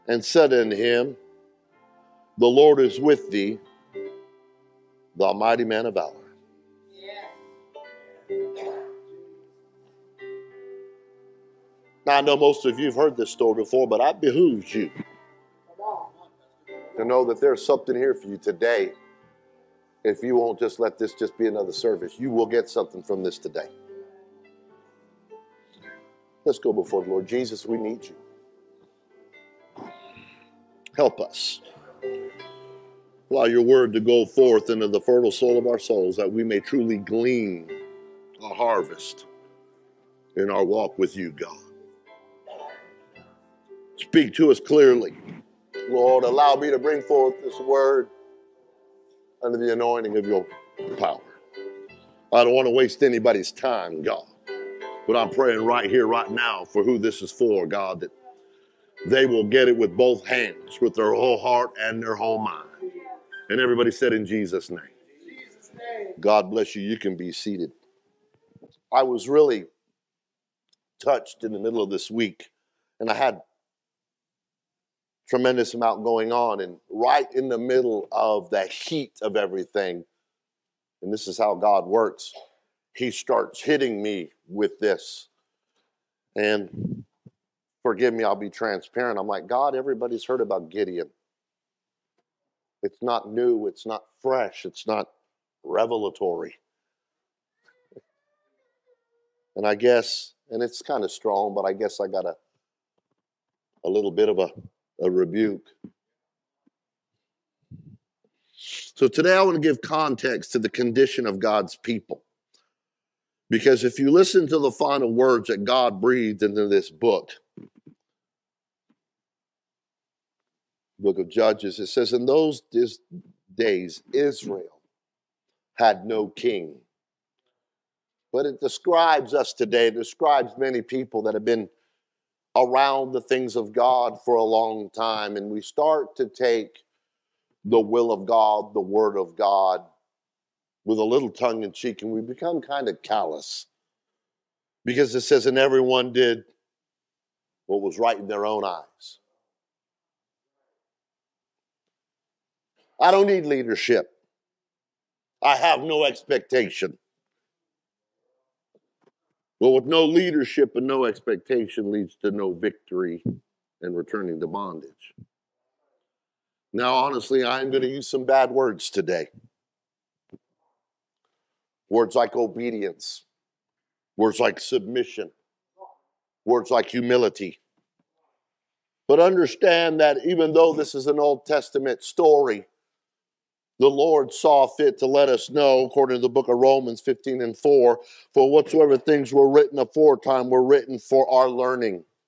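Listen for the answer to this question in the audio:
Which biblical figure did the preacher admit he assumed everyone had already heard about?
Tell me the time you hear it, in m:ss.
1:30.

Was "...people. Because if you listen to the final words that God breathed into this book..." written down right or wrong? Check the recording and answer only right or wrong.
right.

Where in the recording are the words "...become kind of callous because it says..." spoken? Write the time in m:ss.
2:22.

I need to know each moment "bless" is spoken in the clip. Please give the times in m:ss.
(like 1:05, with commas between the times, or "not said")
1:06.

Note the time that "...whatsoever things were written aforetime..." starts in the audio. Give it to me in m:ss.
3:08.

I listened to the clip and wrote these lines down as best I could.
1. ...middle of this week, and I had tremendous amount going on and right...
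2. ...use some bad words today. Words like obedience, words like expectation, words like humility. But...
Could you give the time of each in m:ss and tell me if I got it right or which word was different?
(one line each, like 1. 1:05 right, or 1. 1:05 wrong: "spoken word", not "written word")
1. 1:11 right
2. 2:47 wrong: "submission", not "expectation".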